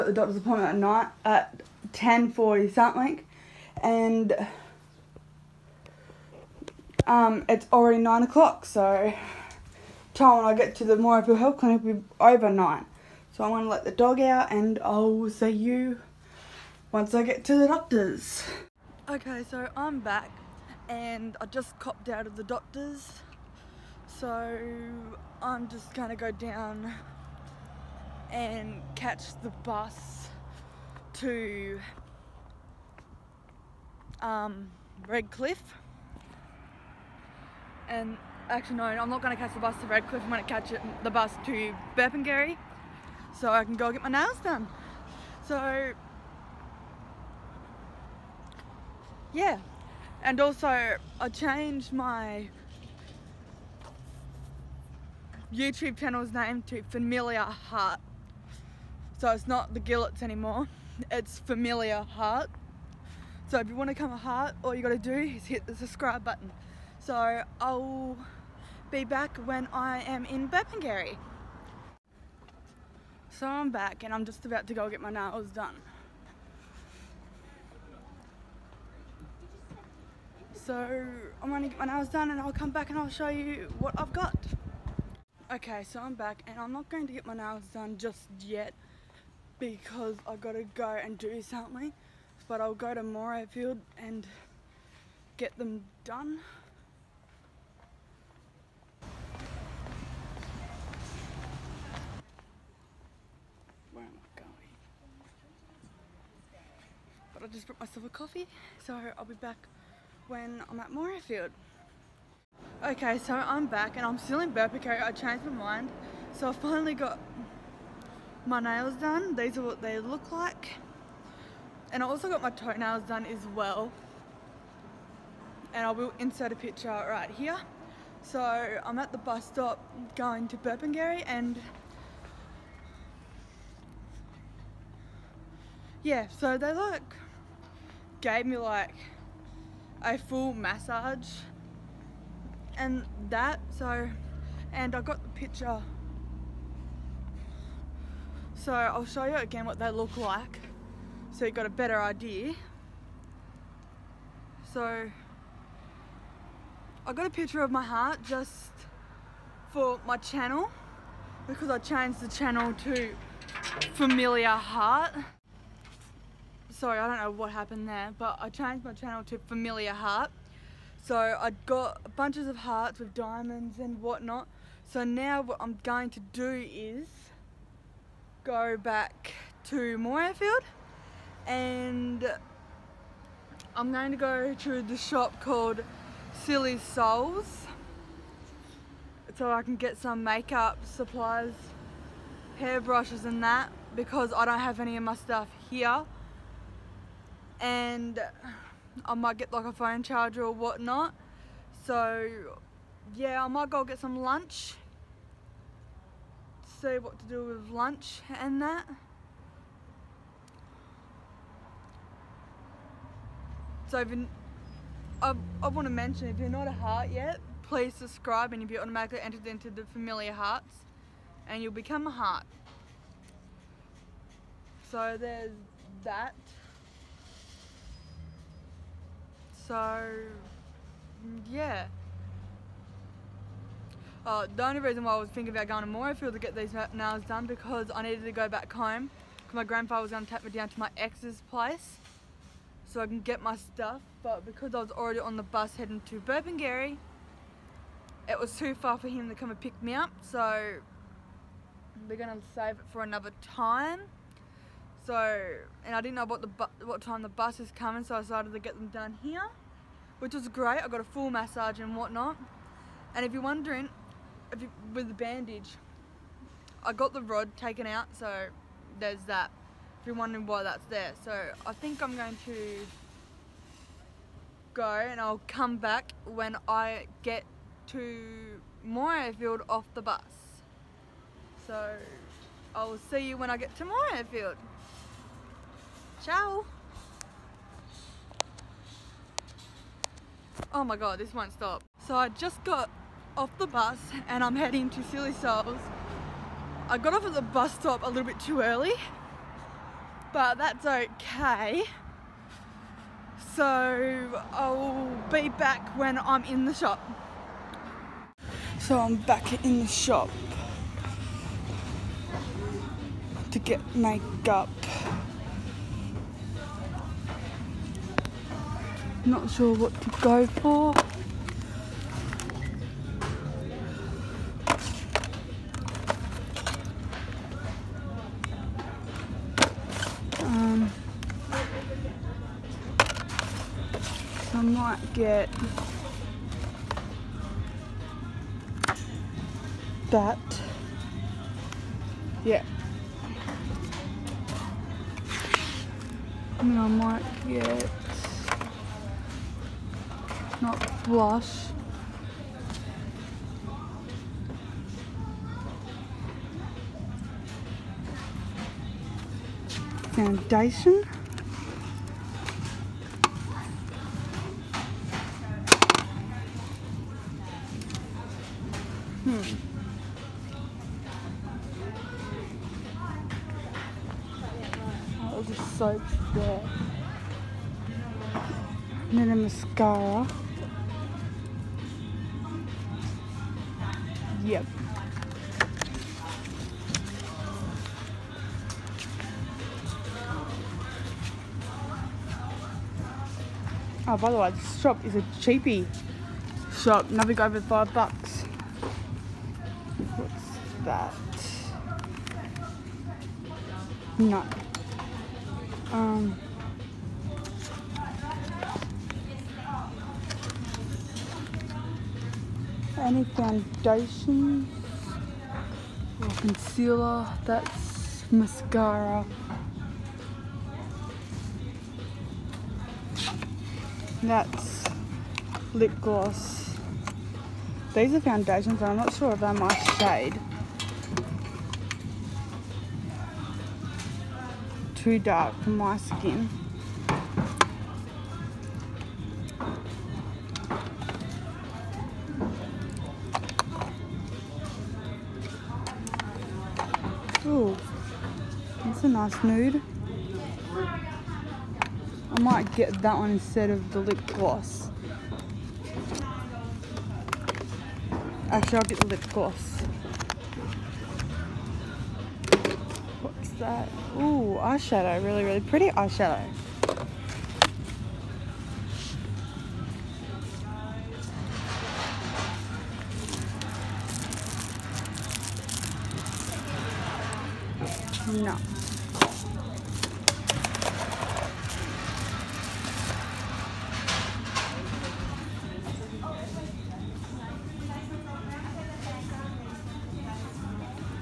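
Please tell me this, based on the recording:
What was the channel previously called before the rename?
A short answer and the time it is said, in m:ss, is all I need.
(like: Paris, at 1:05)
the Gillets, at 0:59.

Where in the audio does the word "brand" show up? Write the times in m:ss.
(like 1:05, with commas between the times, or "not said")
not said.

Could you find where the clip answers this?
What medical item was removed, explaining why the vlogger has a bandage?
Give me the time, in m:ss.
4:27.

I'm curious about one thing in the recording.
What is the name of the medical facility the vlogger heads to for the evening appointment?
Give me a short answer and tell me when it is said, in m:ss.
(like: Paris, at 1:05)
Morayfield Health Clinic, at 0:10.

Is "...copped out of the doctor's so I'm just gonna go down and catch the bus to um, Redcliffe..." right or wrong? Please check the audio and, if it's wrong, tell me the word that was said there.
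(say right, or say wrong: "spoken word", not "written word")
right.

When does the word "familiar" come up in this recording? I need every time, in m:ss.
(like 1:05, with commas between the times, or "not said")
0:56, 1:01, 2:43, 2:49, 3:39.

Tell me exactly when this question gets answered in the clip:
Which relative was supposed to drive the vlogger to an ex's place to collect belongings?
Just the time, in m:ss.
3:59.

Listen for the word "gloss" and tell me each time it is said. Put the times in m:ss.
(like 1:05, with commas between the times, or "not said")
7:05, 7:34, 7:39.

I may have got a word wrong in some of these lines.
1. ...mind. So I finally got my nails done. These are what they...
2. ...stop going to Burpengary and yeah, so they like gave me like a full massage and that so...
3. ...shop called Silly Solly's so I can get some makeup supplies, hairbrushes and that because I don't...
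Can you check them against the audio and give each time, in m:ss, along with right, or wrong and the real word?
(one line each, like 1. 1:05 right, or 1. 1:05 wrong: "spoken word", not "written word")
1. 1:55 right
2. 2:09 right
3. 3:04 right.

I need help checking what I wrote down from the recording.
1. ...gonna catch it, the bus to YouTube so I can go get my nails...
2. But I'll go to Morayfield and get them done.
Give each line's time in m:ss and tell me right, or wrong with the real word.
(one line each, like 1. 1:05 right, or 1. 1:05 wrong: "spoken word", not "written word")
1. 0:40 wrong: "Burpengary", not "YouTube"
2. 1:32 right.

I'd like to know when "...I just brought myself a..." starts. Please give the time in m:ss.
1:47.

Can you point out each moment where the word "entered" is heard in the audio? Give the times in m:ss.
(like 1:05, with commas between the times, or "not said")
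3:39.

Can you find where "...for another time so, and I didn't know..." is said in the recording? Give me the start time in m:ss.
4:12.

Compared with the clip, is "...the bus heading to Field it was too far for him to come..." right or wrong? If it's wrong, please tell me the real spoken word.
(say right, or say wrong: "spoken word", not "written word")
wrong: "Burpengary", not "Field".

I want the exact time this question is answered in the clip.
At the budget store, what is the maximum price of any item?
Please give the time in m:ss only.
6:37.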